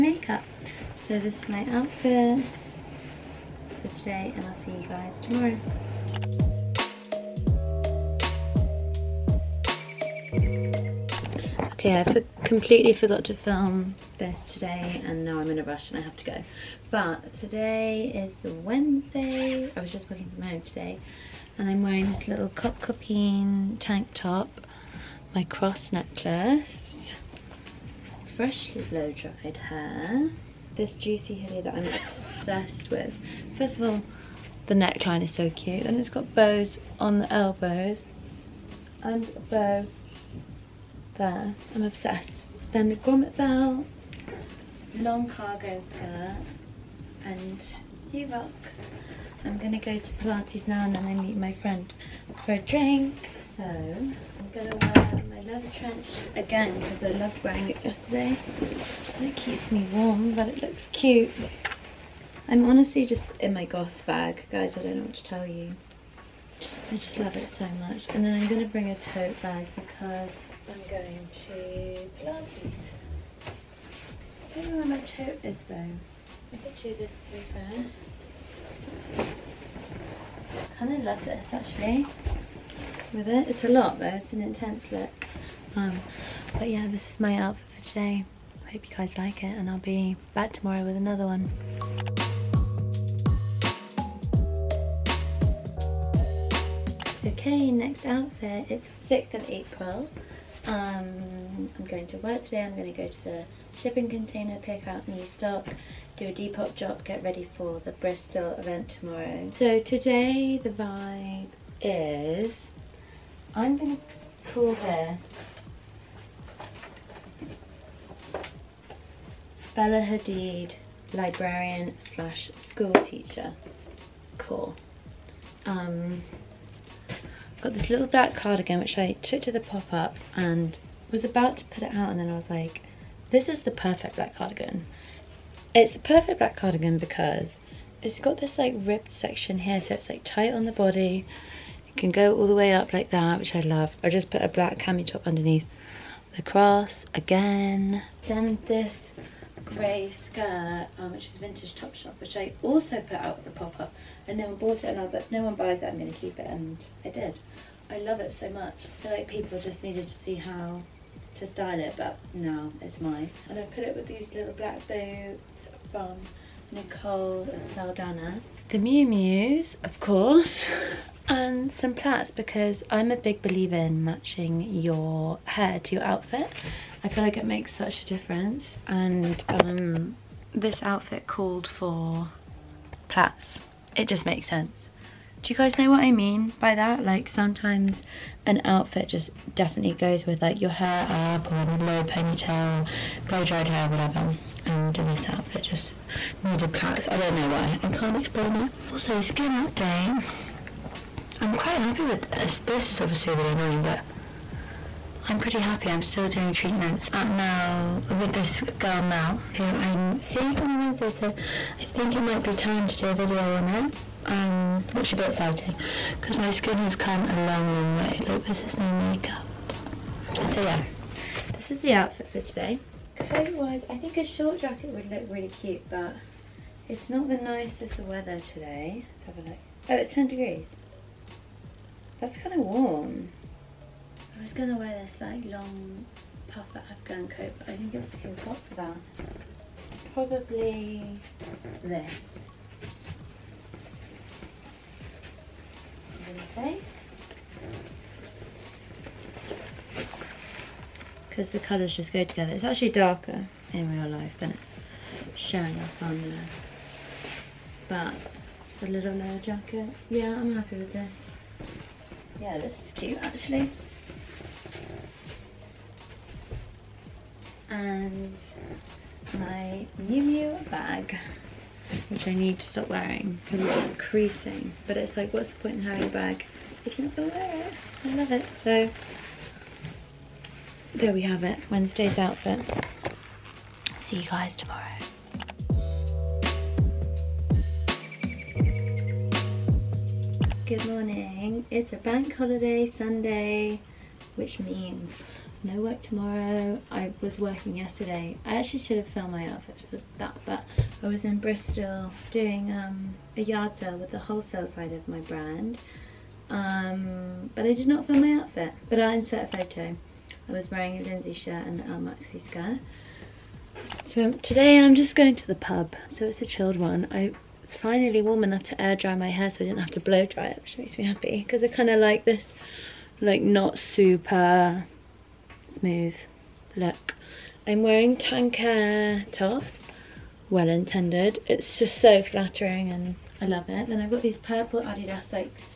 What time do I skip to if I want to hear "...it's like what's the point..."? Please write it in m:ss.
4:34.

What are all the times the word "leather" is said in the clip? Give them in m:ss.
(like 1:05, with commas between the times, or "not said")
0:55, 4:19.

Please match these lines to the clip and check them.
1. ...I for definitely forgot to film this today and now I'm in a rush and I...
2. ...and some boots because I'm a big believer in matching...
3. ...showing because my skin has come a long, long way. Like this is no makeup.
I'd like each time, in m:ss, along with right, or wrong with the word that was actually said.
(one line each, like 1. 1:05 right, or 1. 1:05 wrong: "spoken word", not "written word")
1. 0:12 wrong: "completely", not "definitely"
2. 2:51 wrong: "plaits", not "boots"
3. 3:35 wrong: "exciting", not "showing".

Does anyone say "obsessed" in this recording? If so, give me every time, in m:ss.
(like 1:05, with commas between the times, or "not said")
0:31, 0:41.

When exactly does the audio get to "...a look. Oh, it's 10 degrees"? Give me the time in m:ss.
3:49.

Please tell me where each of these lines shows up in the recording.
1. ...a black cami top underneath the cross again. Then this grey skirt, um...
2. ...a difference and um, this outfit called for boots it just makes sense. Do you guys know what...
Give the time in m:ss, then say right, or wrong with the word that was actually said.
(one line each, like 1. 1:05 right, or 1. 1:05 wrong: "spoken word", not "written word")
1. 2:24 right
2. 2:58 wrong: "plaits", not "boots".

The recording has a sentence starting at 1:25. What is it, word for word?
Um, but yeah, this is my outfit for today.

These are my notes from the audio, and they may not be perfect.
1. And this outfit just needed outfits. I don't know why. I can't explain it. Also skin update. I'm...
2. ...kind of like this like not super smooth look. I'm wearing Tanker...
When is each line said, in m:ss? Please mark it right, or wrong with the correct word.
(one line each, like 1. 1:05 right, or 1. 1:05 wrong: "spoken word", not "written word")
1. 3:14 wrong: "plaits", not "outfits"
2. 5:21 right.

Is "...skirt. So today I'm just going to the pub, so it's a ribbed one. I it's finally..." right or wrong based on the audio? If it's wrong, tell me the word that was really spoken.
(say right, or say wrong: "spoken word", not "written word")
wrong: "chilled", not "ribbed".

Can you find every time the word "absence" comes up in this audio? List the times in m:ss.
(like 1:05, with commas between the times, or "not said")
not said.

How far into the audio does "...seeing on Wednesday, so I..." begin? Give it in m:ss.
3:30.